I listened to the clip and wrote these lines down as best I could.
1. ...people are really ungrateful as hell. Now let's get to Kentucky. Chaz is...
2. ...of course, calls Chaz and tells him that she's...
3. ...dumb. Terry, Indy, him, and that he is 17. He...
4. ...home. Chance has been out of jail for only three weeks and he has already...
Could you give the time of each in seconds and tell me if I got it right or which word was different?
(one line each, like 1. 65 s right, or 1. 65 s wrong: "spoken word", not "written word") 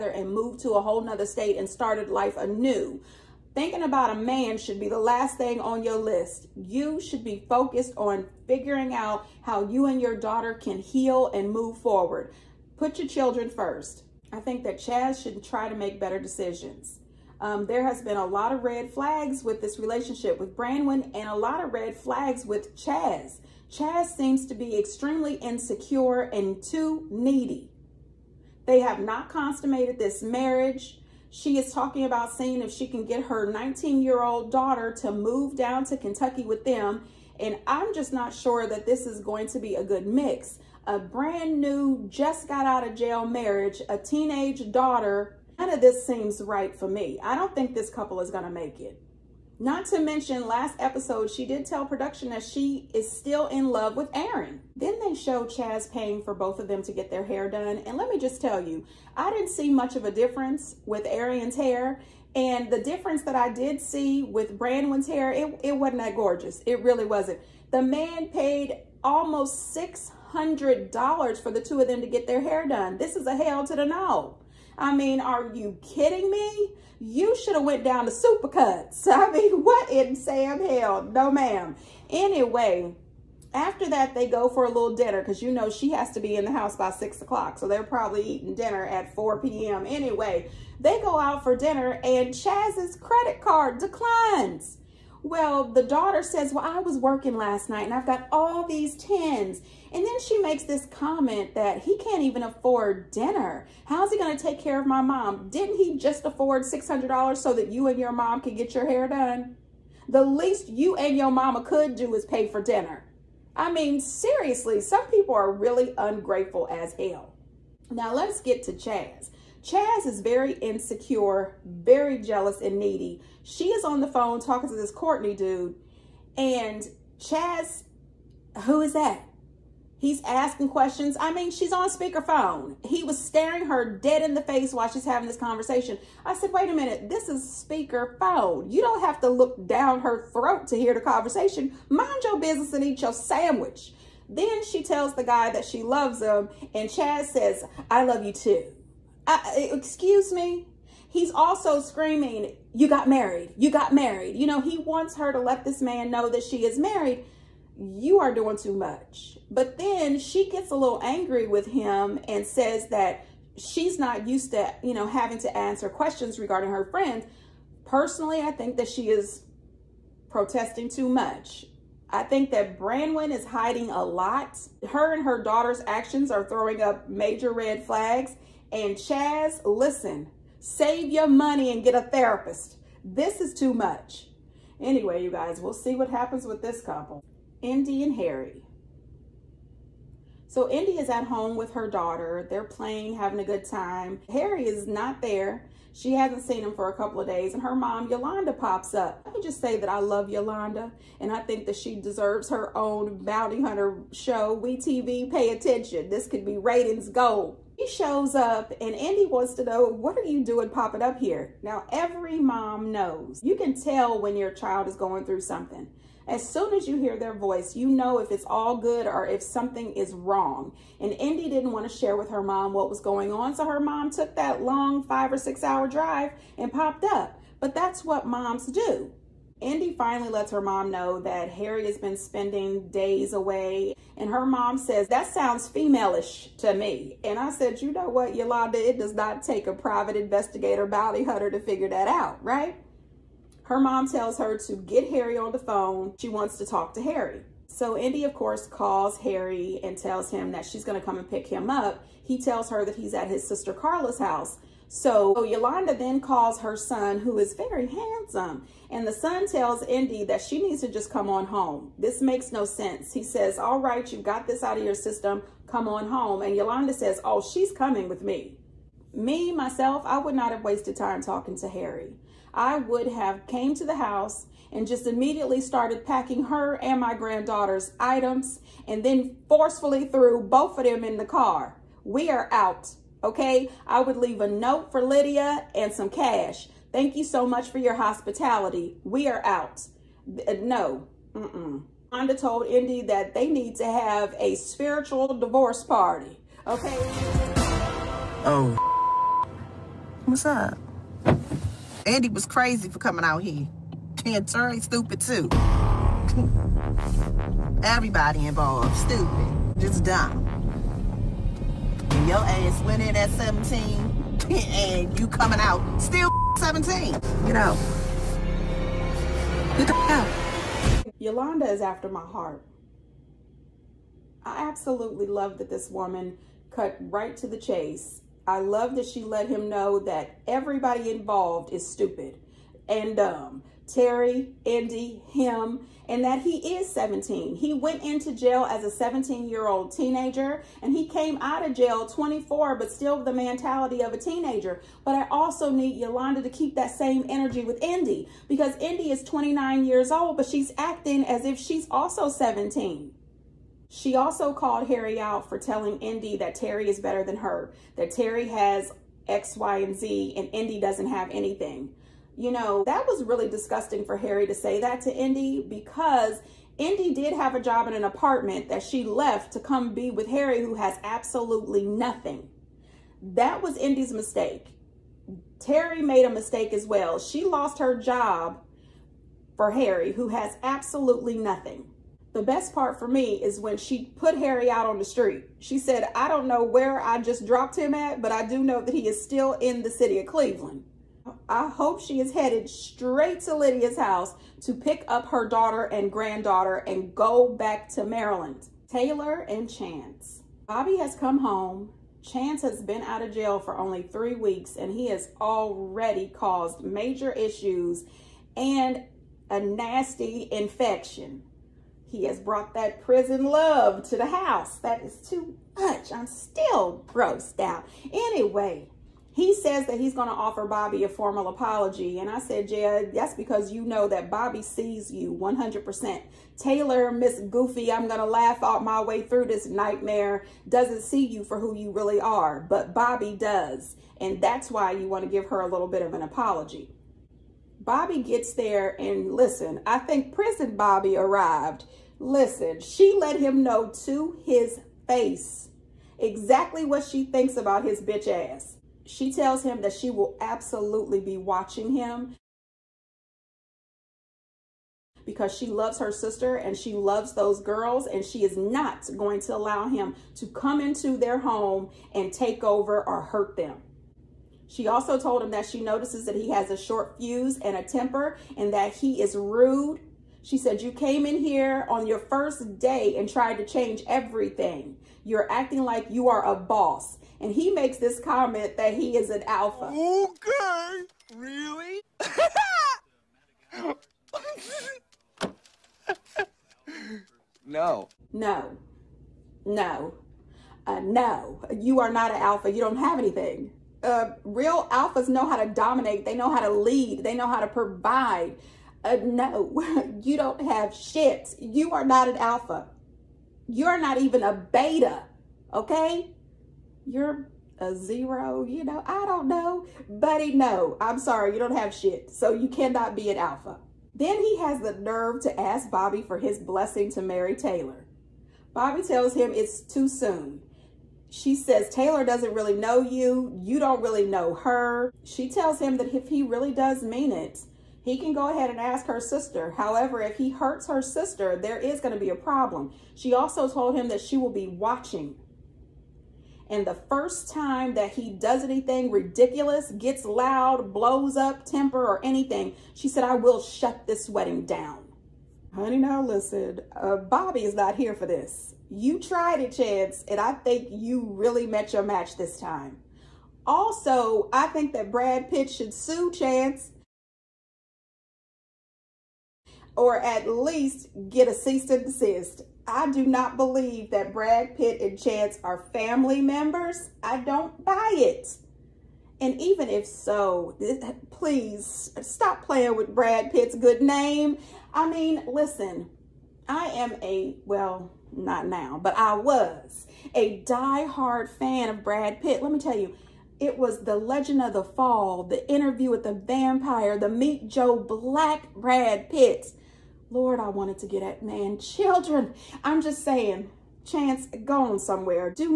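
1. 115 s wrong: "Chaz", not "Kentucky"
2. 248 s wrong: "Harry", not "Chaz"
3. 333 s right
4. 401 s right.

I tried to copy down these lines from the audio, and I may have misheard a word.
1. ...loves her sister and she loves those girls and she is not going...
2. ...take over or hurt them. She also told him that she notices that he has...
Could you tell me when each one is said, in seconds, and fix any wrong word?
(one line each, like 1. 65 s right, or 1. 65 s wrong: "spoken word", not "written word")
1. 455 s right
2. 462 s right.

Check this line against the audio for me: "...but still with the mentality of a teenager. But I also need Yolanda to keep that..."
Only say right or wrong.
right.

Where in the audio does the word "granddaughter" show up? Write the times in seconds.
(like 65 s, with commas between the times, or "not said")
277 s, 396 s.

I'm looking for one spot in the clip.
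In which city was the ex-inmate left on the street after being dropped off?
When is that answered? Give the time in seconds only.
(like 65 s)
390 s.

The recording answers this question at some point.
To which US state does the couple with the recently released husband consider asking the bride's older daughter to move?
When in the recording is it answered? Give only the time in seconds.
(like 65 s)
35 s.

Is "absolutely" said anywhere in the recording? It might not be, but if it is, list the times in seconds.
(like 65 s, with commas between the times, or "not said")
324 s, 371 s, 380 s, 450 s.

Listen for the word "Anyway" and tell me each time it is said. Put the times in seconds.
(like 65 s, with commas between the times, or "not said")
82 s, 89 s, 184 s, 418 s.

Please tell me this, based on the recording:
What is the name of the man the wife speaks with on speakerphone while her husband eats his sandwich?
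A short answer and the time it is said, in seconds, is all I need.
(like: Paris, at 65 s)
Courtney, at 124 s.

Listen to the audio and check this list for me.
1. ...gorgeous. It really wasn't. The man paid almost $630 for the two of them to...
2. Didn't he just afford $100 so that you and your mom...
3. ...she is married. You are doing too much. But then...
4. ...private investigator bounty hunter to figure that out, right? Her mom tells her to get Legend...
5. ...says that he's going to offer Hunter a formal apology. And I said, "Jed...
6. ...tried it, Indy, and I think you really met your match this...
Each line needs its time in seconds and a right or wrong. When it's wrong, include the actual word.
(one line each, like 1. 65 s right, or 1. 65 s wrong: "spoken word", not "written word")
1. 66 s wrong: "600", not "630"
2. 105 s wrong: "600", not "100"
3. 156 s right
4. 239 s wrong: "Harry", not "Legend"
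5. 419 s wrong: "Bobby", not "Hunter"
6. 549 s wrong: "Chance", not "Indy".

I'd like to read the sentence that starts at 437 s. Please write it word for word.
Bobby gets there and listen, I think prison Bobby arrived.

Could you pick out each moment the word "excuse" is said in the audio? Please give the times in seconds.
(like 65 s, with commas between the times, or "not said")
149 s.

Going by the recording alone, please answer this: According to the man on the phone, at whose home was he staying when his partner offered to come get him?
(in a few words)
Carla.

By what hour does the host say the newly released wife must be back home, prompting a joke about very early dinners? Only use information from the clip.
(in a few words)
6 o'clock.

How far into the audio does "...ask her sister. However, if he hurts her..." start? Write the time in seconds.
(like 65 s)
528 s.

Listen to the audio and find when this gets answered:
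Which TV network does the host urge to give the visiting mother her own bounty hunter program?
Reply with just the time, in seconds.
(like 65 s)
204 s.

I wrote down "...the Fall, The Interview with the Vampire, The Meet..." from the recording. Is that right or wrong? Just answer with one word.
right.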